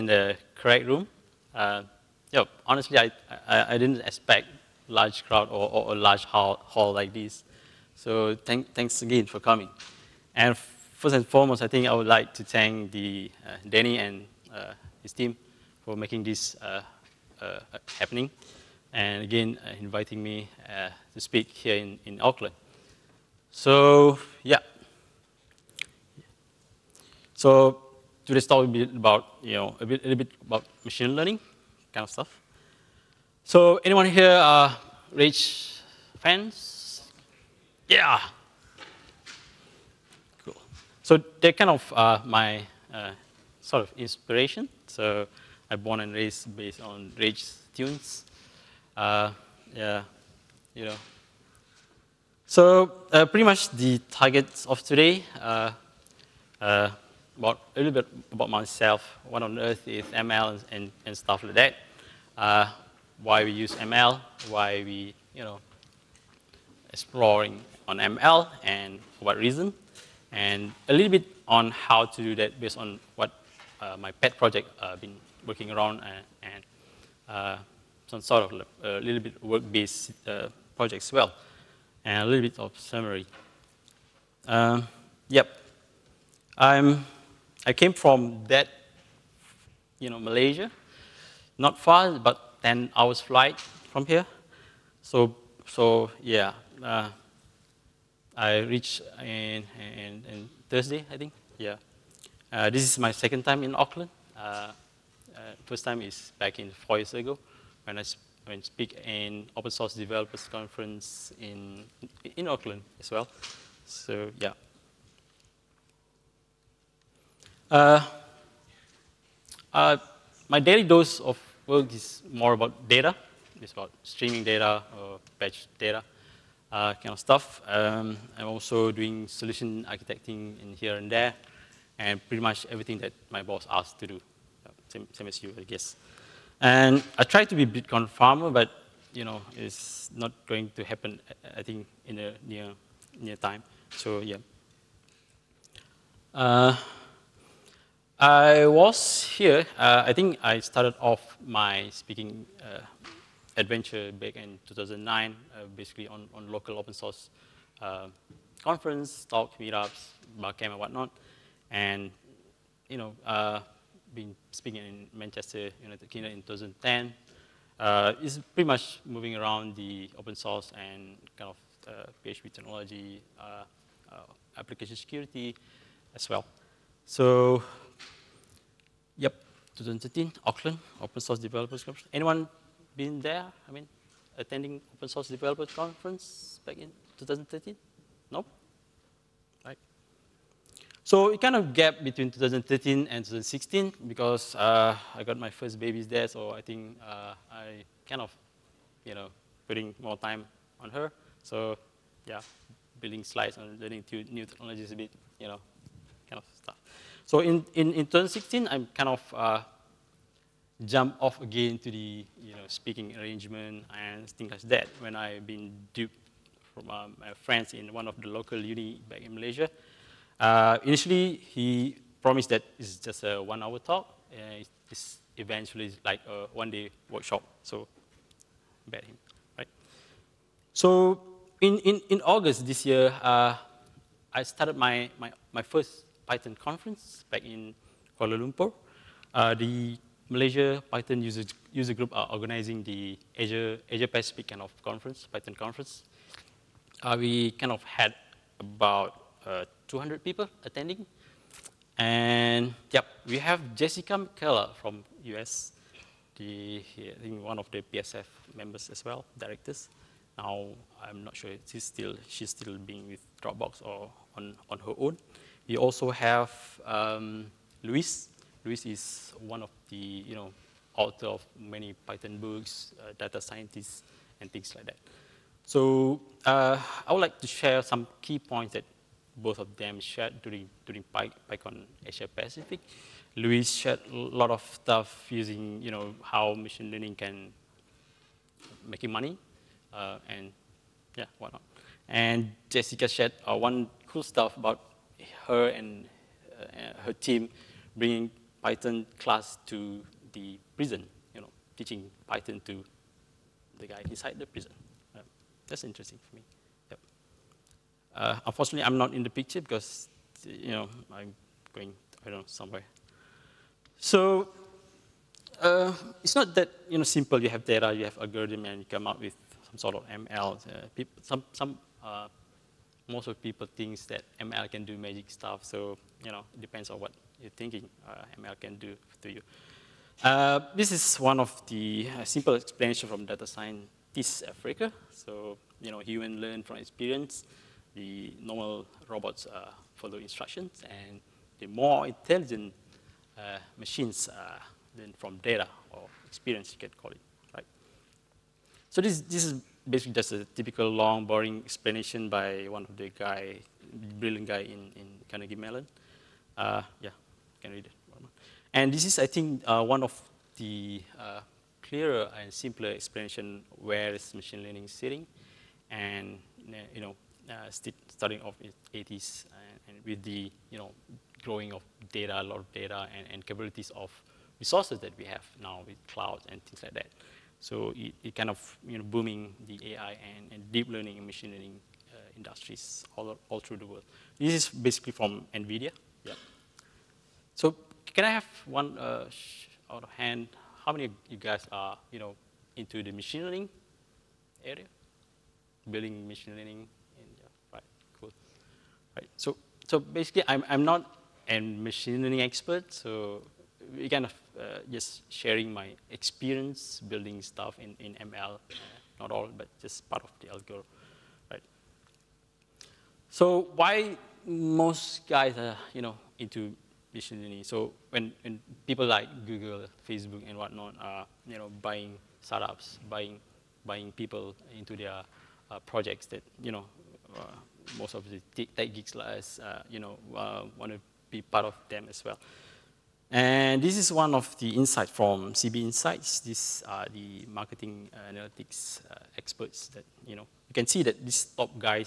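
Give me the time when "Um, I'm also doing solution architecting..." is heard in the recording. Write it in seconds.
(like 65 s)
127 s.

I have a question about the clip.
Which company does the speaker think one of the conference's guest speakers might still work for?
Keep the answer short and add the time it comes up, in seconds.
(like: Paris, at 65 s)
Dropbox, at 263 s.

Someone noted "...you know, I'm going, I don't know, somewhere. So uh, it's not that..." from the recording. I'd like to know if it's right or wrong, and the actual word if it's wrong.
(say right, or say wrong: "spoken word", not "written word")
right.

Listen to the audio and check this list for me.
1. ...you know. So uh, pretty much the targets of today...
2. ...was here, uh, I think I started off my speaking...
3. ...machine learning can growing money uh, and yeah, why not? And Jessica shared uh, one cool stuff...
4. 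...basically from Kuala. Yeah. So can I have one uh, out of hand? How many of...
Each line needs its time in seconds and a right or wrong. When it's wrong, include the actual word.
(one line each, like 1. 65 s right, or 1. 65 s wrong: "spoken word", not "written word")
1. 50 s right
2. 148 s right
3. 286 s wrong: "making", not "growing"
4. 384 s wrong: "NVIDIA", not "Kuala".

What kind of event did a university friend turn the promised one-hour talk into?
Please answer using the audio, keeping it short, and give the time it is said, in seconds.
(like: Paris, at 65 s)
one-day workshop, at 226 s.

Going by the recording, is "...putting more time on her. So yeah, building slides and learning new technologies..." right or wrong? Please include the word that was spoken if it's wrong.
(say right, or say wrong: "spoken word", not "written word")
right.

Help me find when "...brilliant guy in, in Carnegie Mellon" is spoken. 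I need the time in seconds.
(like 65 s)
354 s.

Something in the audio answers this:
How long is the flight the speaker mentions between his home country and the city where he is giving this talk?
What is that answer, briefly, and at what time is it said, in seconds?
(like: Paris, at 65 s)
10 hours, at 92 s.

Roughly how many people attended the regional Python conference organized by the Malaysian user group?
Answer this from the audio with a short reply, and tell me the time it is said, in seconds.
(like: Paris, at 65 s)
200, at 249 s.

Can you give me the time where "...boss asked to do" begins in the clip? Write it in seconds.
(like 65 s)
133 s.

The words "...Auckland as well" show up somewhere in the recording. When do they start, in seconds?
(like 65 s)
112 s.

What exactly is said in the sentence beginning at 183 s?
I mean, attending Open Source Developers Conference back in 2013?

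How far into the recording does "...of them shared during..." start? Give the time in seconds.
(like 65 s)
279 s.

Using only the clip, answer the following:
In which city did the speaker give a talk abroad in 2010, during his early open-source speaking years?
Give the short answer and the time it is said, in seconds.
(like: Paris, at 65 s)
Manchester, at 165 s.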